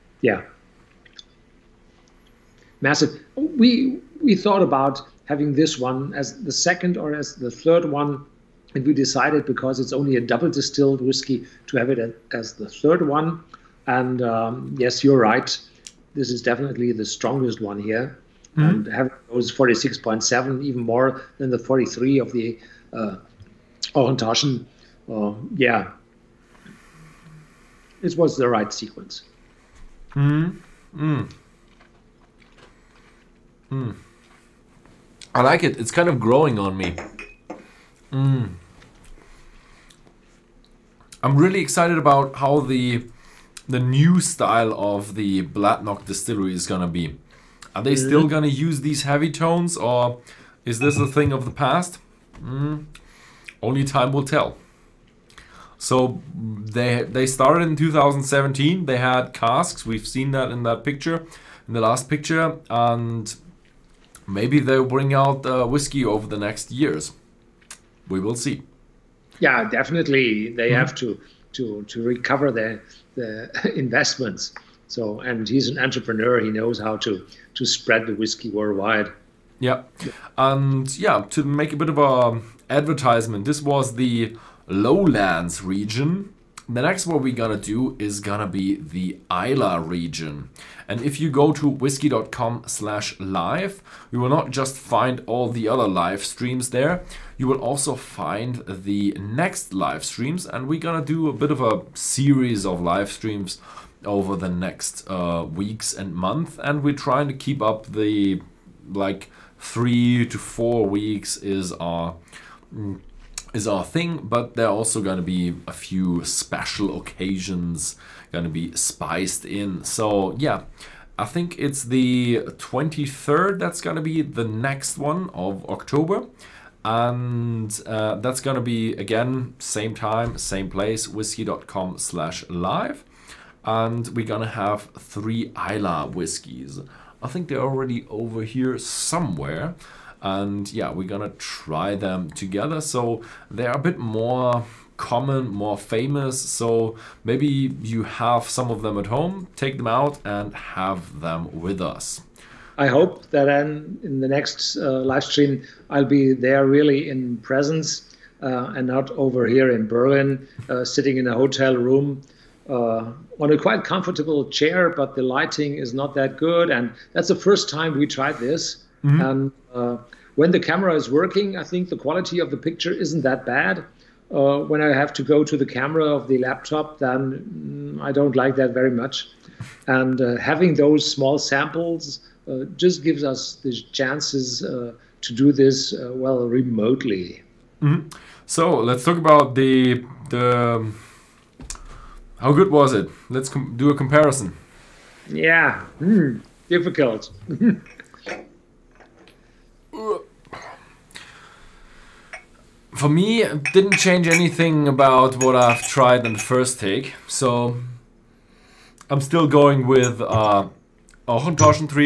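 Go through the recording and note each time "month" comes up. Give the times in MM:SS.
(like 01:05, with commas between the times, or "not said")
01:46.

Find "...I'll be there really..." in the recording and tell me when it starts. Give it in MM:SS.
02:35.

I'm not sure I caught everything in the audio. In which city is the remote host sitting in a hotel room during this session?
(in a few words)
Berlin.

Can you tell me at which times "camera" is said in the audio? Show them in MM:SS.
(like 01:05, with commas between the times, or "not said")
02:50, 02:55.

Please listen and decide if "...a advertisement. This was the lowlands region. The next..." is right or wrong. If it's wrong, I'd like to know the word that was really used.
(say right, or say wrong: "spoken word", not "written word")
right.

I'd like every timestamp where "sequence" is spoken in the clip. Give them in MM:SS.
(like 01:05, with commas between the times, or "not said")
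00:28.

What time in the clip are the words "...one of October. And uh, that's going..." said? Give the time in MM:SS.
02:04.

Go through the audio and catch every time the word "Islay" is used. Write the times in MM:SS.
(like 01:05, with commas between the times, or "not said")
01:29, 02:15.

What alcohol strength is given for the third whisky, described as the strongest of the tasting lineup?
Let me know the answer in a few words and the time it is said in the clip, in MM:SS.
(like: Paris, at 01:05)
46.7, at 00:19.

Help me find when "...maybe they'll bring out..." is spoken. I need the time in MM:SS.
01:04.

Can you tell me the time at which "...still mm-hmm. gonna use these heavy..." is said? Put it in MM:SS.
00:47.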